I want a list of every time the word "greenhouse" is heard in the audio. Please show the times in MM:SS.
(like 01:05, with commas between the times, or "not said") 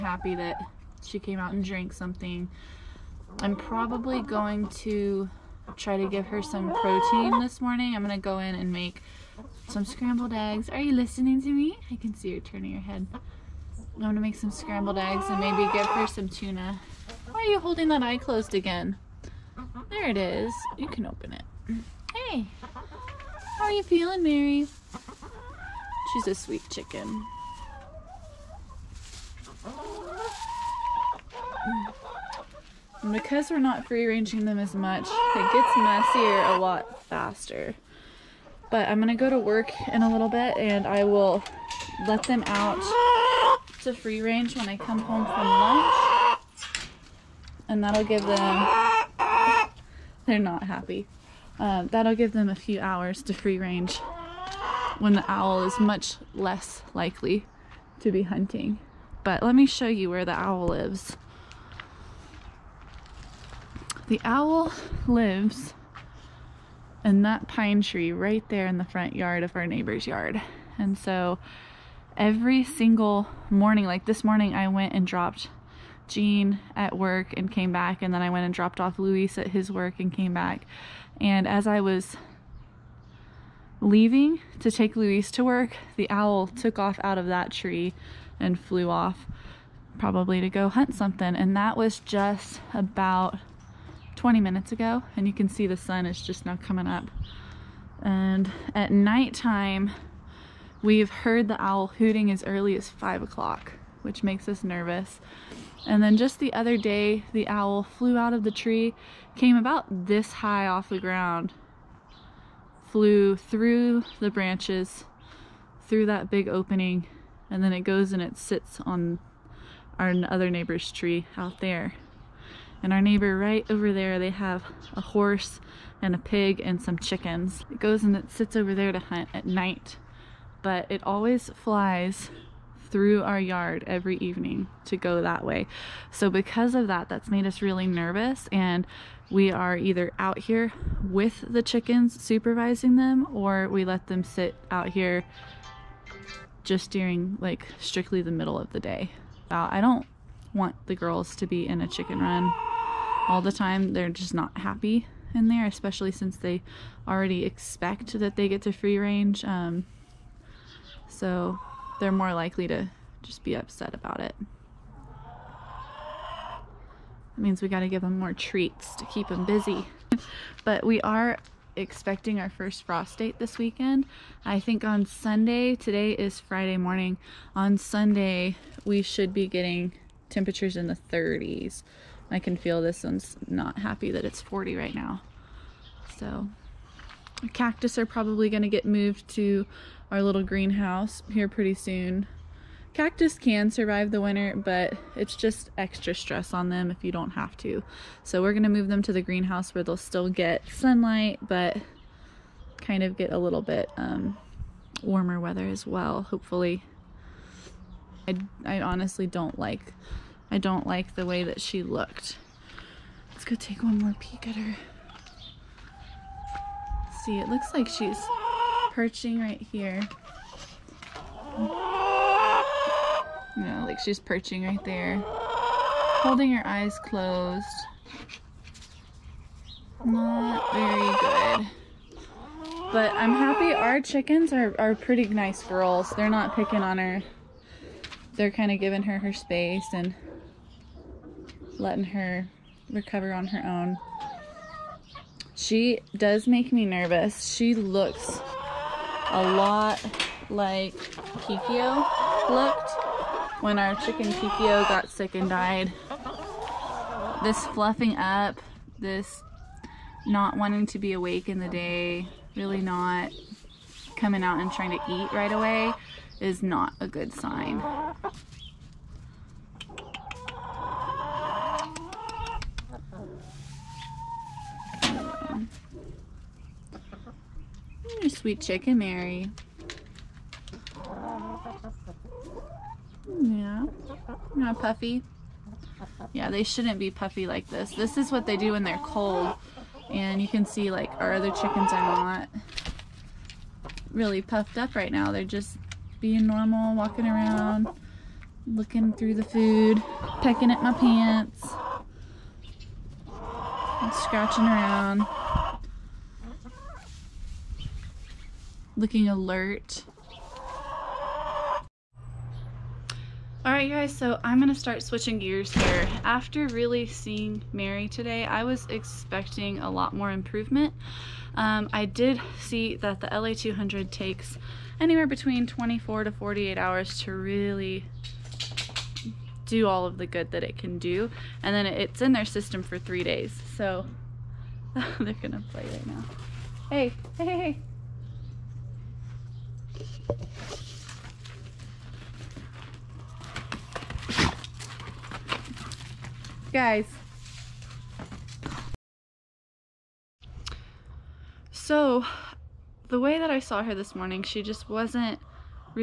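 03:10, 03:19.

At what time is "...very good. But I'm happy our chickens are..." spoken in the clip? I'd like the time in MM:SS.
03:50.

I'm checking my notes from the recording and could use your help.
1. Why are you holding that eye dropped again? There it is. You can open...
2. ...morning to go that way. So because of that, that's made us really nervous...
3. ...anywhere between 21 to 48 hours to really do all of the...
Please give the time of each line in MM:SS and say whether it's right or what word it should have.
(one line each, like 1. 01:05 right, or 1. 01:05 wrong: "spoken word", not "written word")
1. 00:17 wrong: "closed", not "dropped"
2. 02:14 wrong: "evening", not "morning"
3. 05:24 wrong: "24", not "21".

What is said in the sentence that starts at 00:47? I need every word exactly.
And that'll give them, they're not happy.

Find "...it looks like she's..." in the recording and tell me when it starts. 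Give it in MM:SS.
03:37.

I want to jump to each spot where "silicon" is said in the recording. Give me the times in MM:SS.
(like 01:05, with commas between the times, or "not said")
not said.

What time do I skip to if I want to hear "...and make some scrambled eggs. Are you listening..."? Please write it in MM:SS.
00:08.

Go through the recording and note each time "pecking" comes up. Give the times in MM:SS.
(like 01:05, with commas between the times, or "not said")
05:00.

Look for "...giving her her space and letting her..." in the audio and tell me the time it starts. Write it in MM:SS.
03:58.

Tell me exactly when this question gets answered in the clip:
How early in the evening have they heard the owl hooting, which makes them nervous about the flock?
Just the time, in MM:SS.
01:42.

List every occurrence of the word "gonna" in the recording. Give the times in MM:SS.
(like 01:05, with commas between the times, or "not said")
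00:08, 00:14, 00:38, 03:18, 05:14, 05:35.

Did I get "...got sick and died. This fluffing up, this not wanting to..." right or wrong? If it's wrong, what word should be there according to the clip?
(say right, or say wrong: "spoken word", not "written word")
right.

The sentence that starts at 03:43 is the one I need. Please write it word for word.
You know, like she's perching right there.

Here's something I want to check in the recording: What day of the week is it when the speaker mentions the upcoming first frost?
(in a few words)
Friday.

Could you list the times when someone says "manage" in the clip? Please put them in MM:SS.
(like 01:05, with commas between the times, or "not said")
not said.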